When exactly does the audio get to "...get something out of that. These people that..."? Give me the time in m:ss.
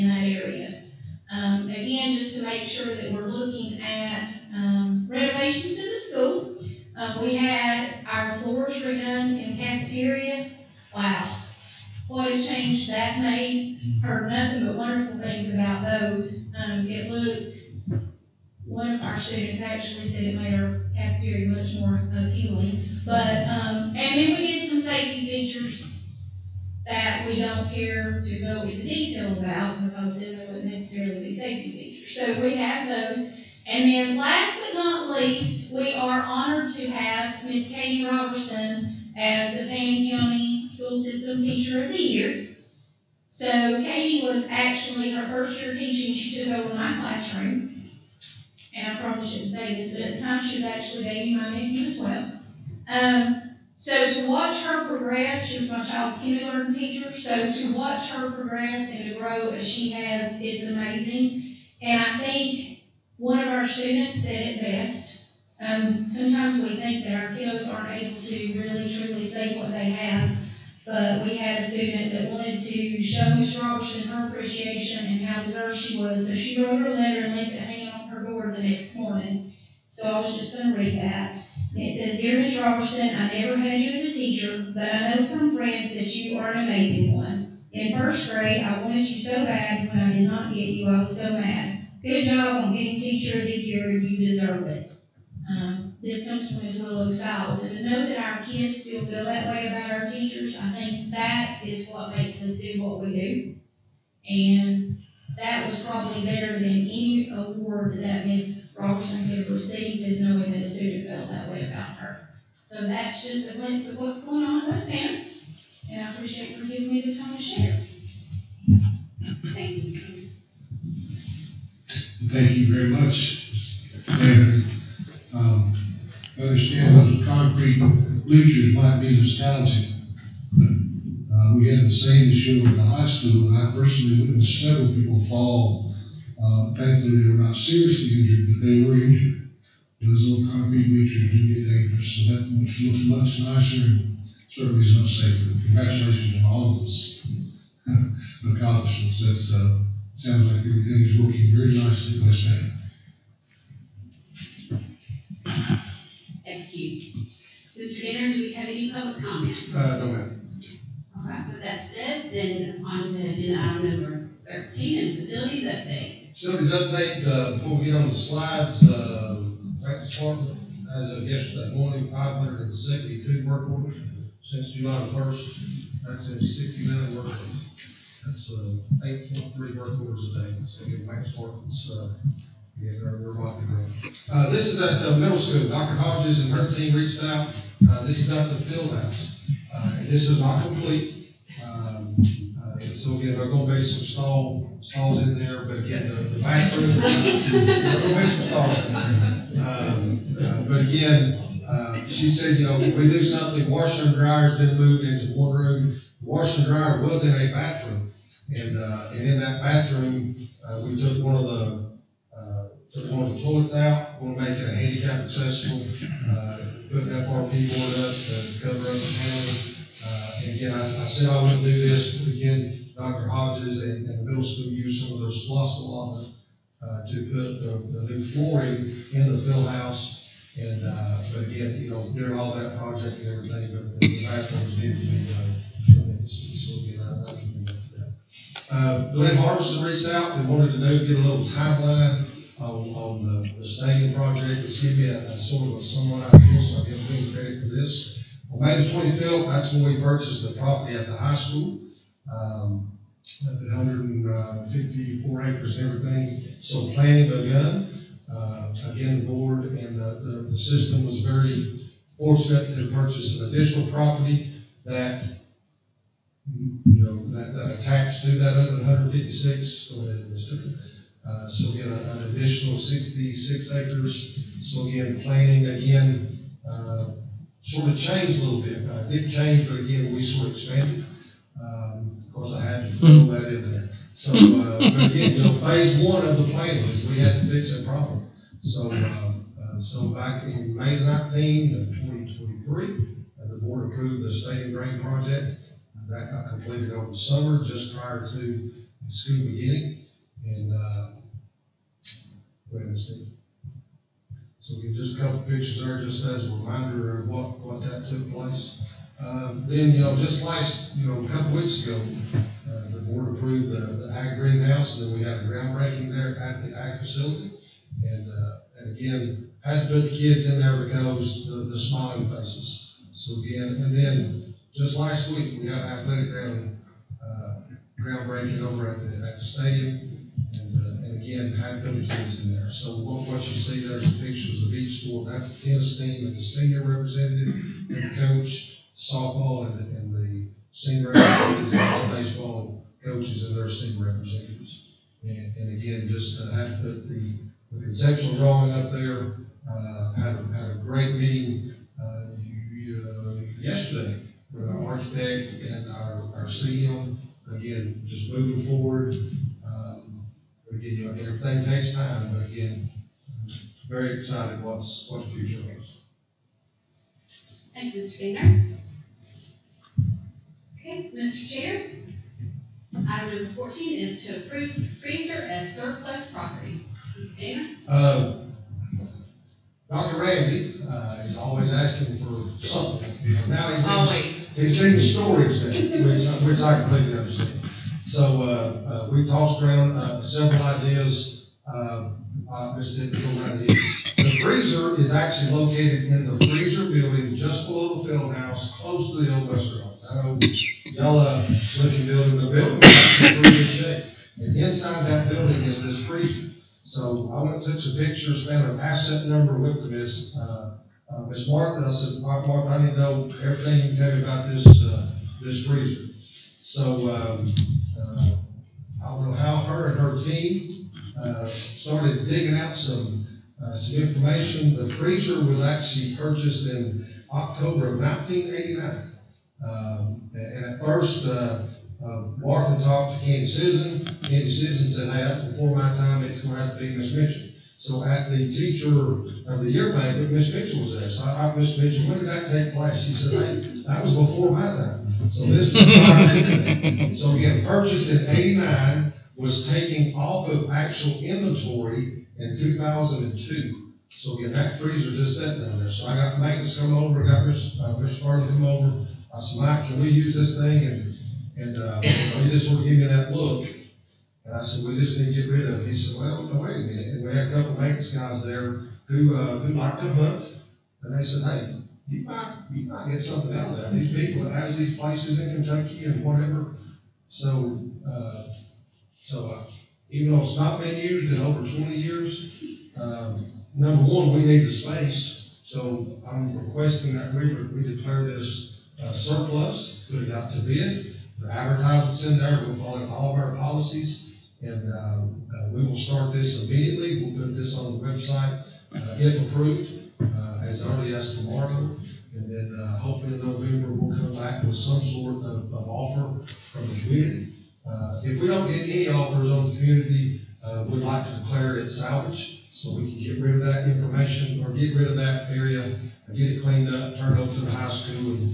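7:53.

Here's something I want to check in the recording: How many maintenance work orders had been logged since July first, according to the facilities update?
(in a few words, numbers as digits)
572.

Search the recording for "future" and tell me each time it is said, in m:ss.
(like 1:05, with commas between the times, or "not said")
6:05.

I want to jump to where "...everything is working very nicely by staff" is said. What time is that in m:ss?
2:30.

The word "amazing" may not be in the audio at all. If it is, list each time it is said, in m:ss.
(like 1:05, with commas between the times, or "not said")
1:00, 1:26.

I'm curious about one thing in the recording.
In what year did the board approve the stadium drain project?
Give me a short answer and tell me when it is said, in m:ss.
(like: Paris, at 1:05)
2023, at 4:51.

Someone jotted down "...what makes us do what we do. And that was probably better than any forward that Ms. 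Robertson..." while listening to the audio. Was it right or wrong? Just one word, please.
wrong.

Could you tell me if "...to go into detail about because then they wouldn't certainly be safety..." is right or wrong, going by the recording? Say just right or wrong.
wrong.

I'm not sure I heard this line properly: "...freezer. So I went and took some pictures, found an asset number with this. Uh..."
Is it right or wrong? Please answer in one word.
right.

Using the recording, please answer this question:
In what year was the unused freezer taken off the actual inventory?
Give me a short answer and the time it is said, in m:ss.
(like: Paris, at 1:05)
2002, at 7:32.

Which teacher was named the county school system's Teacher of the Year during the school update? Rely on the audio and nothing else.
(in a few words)
Katie Robertson.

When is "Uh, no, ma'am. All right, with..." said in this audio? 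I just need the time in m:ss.
2:39.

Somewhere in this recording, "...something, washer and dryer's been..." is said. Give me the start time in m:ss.
3:23.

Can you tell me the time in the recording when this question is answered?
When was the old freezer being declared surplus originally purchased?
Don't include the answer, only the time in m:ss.
7:07.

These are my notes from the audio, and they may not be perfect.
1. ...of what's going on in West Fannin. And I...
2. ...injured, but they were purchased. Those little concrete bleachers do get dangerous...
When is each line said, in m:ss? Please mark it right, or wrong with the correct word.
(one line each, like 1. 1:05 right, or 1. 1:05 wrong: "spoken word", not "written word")
1. 1:53 right
2. 2:18 wrong: "injured", not "purchased".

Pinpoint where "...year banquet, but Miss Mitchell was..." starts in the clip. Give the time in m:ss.
7:19.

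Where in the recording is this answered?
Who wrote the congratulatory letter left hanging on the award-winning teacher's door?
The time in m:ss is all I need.
1:36.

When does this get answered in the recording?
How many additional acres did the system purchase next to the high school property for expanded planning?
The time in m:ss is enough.
4:32.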